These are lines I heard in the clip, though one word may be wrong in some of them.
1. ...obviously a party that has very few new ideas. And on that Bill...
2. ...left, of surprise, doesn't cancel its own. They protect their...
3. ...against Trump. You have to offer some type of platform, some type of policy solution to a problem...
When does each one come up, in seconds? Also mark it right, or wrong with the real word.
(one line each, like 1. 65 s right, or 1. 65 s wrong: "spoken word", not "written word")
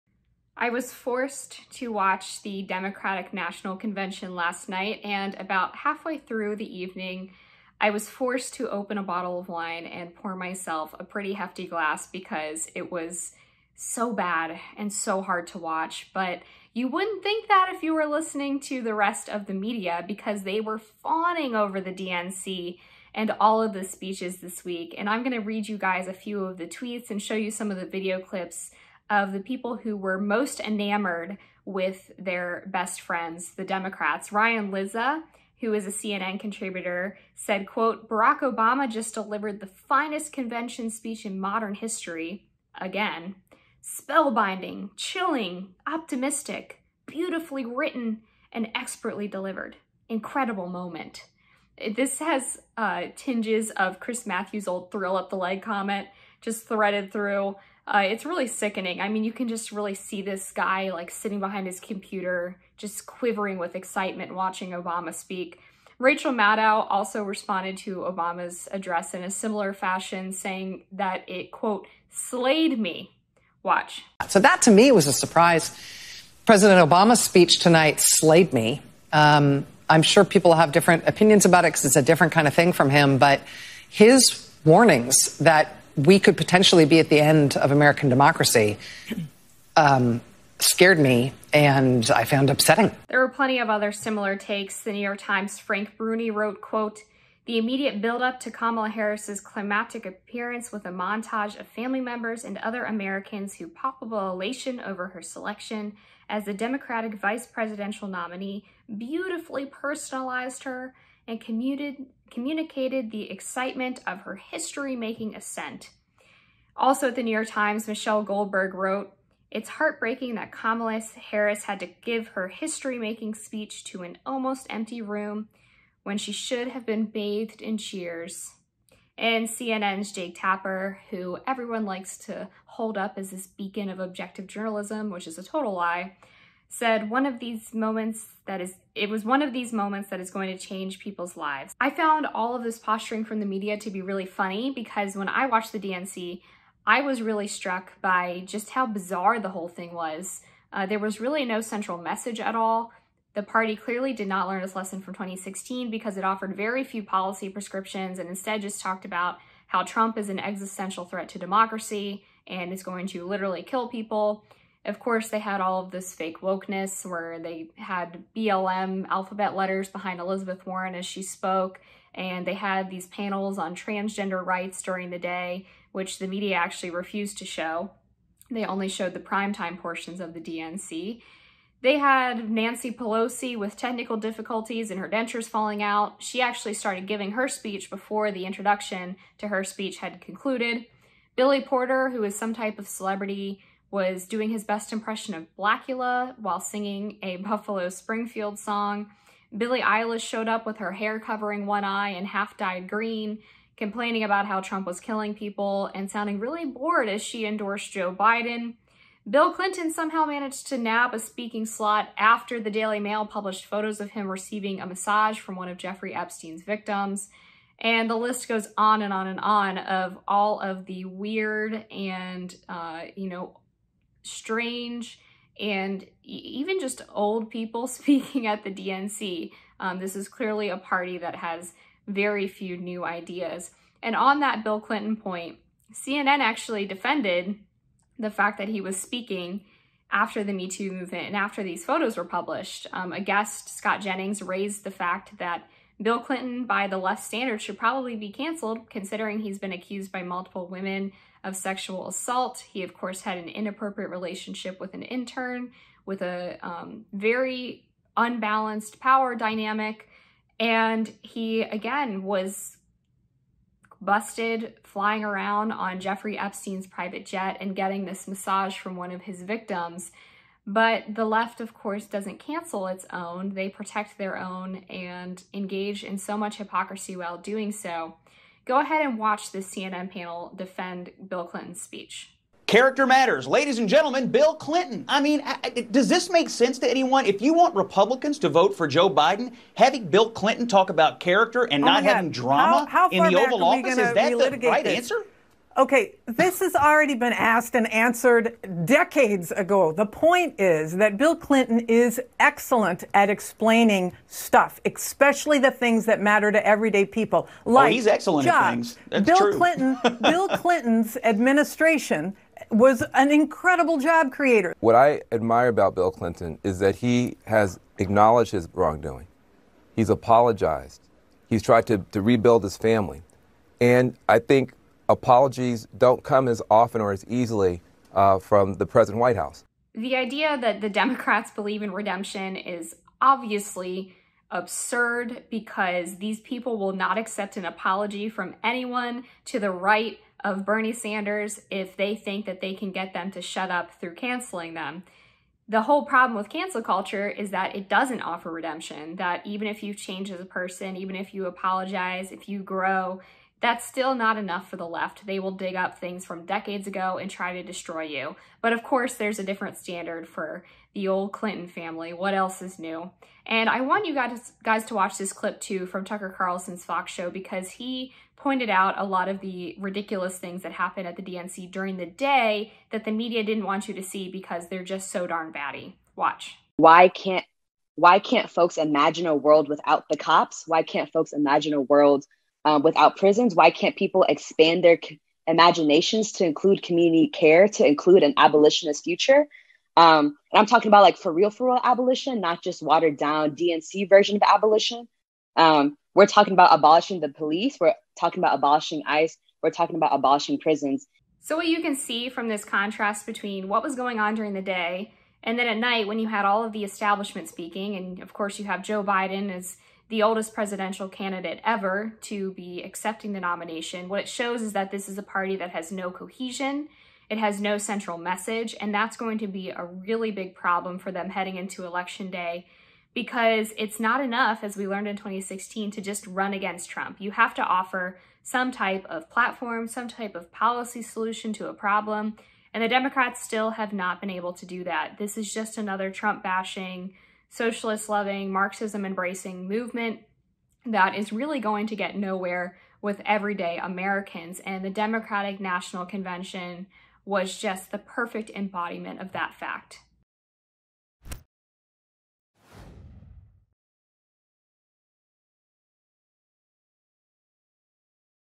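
1. 230 s wrong: "clearly", not "obviously"
2. 271 s wrong: "course", not "surprise"
3. 426 s right.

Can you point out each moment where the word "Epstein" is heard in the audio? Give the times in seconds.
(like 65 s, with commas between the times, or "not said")
216 s, 266 s.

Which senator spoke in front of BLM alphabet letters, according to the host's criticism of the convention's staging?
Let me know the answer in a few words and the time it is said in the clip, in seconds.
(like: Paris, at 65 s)
Elizabeth Warren, at 170 s.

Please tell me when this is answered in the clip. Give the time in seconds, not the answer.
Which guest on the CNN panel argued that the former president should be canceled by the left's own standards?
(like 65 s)
243 s.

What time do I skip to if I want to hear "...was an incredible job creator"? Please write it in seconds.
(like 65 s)
312 s.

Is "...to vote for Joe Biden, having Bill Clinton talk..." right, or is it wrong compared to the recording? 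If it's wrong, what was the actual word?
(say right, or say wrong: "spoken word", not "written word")
right.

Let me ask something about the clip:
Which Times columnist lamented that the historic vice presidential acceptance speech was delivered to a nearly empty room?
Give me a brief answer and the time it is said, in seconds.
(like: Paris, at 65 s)
Michelle Goldberg, at 117 s.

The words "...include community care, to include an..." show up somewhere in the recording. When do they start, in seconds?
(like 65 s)
386 s.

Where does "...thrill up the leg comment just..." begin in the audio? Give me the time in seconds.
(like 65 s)
54 s.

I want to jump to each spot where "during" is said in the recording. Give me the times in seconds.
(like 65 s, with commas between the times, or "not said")
174 s, 371 s, 404 s.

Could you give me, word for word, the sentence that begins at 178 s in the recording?
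They only showed the primetime portions of the DNC.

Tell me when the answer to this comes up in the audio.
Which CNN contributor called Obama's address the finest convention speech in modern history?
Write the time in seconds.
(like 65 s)
34 s.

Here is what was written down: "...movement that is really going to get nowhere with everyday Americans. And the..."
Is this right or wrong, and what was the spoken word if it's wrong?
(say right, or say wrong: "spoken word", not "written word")
right.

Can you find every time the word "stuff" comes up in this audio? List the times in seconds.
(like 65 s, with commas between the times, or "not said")
304 s.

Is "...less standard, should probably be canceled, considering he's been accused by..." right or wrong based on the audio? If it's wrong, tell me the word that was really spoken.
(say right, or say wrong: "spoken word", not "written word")
right.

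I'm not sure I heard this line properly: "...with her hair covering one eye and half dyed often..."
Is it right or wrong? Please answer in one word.
wrong.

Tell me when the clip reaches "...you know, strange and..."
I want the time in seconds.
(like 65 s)
223 s.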